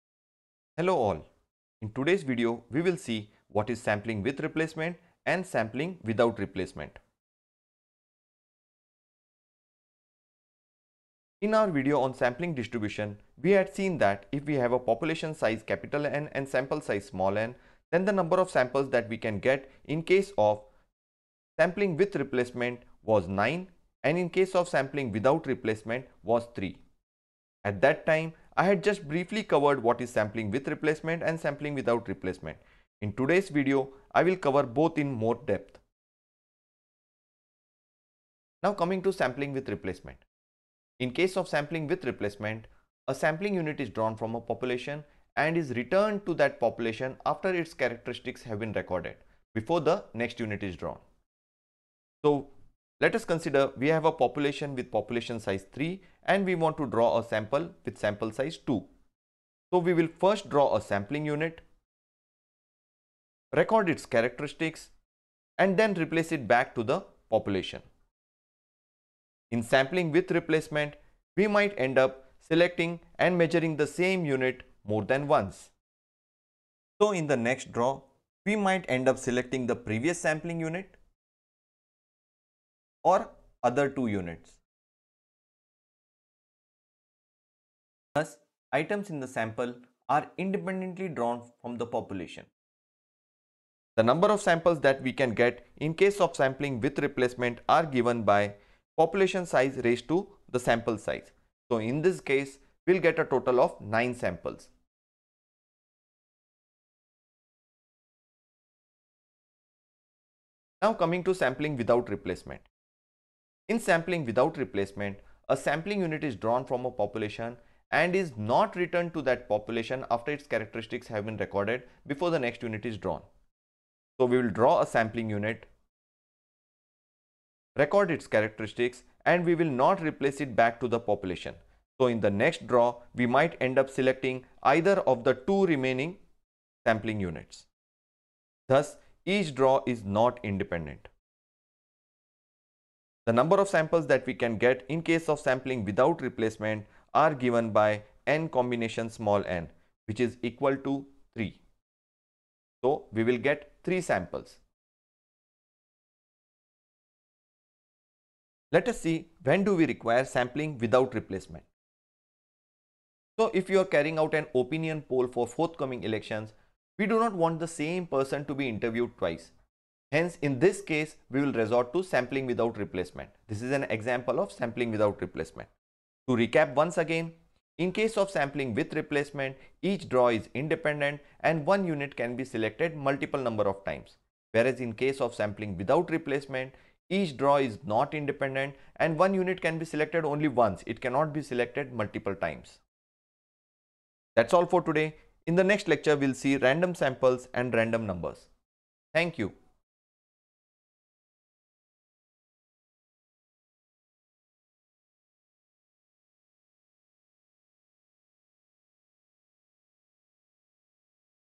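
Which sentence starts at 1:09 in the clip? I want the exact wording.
In sampling with replacement, we might end up selecting and measuring the same unit more than once.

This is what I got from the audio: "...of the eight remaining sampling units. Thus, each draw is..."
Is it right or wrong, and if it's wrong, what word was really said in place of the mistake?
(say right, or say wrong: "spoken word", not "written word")
wrong: "two", not "eight".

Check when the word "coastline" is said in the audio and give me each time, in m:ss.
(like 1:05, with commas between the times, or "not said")
not said.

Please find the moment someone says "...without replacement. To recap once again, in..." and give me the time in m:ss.
2:54.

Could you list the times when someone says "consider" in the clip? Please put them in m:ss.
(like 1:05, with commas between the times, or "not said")
0:53.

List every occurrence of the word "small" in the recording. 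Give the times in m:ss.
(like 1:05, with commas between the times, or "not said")
0:17, 2:29.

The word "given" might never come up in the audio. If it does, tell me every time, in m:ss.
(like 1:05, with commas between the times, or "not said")
1:37, 2:27.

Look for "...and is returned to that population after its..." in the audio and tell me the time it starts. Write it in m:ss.
0:45.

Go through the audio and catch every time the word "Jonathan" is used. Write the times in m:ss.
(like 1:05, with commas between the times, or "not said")
not said.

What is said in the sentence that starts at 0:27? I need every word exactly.
At that time, I had just briefly covered what is sampling with replacement and sampling without replacement.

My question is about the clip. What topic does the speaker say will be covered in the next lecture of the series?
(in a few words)
Random samples and random numbers.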